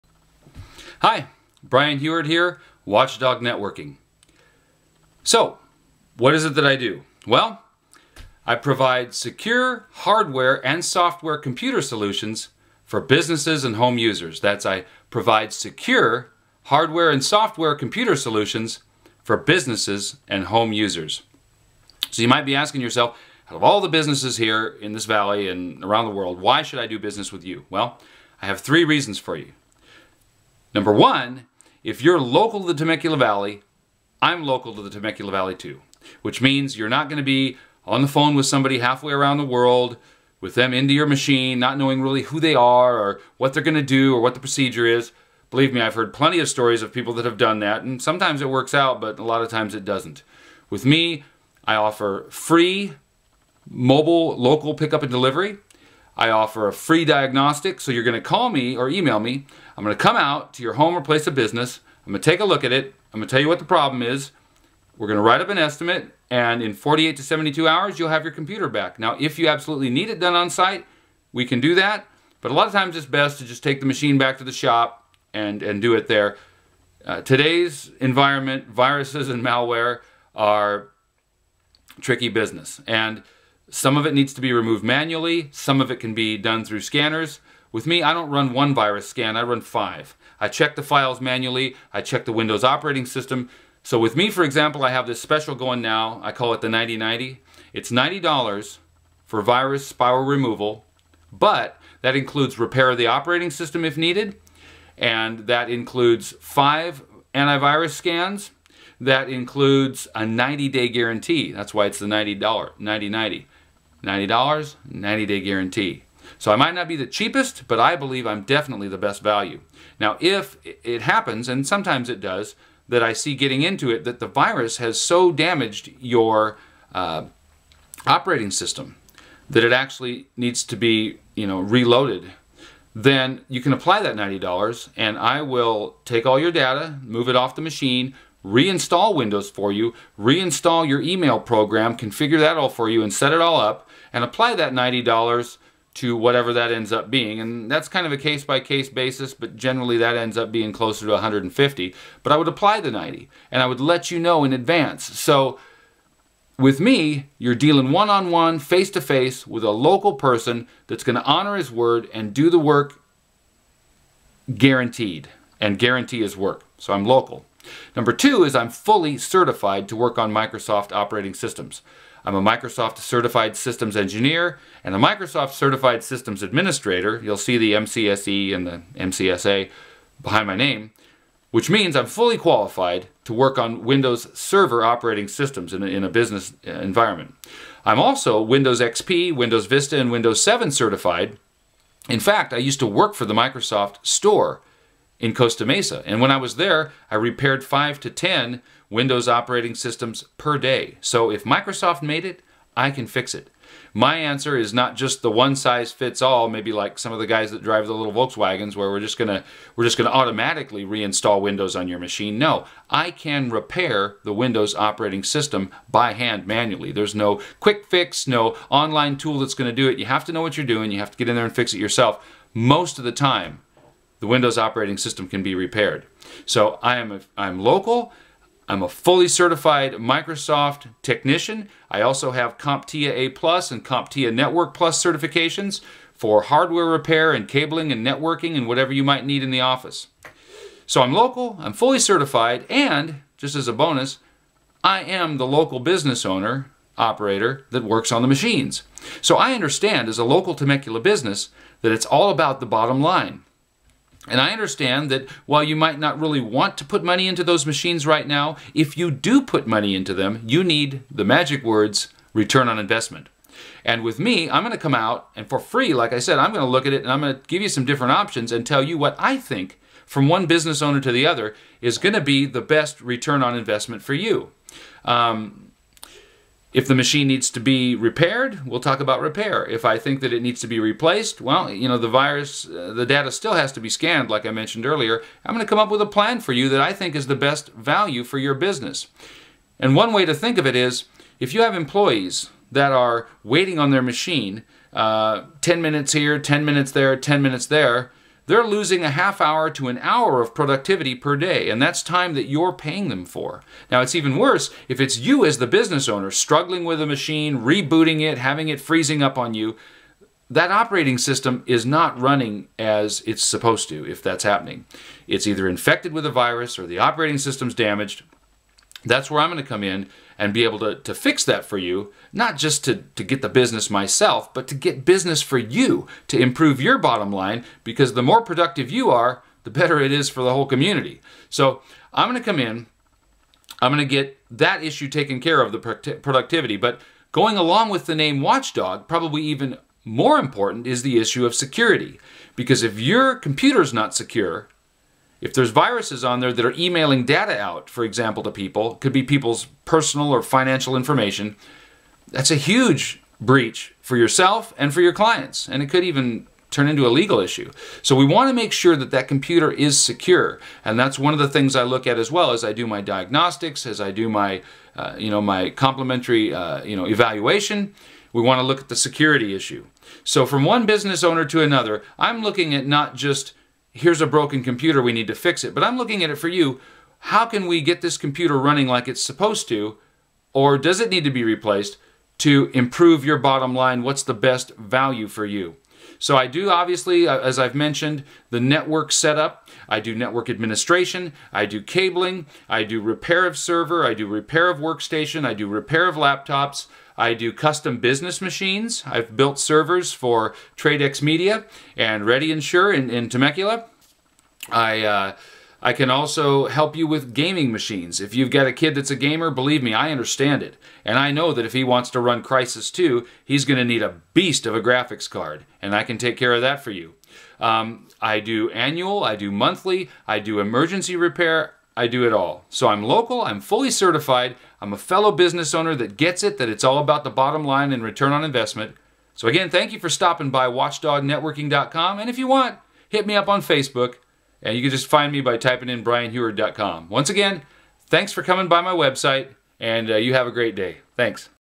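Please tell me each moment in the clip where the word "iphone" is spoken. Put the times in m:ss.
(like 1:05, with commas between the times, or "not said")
not said.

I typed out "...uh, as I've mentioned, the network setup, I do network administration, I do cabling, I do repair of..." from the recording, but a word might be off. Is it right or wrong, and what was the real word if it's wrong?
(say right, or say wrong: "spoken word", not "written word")
right.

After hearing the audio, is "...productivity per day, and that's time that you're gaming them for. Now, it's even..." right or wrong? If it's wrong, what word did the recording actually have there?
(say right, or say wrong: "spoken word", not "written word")
wrong: "paying", not "gaming".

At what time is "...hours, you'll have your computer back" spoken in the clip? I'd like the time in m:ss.
1:07.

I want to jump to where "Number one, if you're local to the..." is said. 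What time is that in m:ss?
0:30.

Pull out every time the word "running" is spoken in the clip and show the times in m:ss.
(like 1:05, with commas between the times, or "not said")
5:12, 6:18.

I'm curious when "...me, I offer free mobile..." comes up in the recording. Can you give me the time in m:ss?
0:50.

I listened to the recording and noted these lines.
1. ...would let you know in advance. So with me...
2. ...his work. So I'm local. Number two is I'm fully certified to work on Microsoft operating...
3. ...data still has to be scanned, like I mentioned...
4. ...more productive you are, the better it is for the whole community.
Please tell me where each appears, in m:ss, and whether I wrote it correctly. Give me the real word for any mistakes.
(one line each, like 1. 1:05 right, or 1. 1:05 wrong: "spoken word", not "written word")
1. 2:33 right
2. 2:46 right
3. 4:43 right
4. 5:28 right.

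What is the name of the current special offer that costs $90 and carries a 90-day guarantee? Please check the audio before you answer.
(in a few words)
9090.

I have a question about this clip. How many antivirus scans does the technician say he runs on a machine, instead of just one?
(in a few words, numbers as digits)
5.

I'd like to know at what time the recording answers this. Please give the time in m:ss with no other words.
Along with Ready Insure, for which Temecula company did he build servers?
6:40.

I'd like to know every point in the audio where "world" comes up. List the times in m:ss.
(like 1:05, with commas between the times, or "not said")
0:26, 0:39.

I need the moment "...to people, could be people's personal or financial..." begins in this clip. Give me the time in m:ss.
5:48.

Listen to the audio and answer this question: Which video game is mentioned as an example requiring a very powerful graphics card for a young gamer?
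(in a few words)
Crysis 2.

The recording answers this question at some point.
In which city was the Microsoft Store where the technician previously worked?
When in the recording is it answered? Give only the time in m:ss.
3:15.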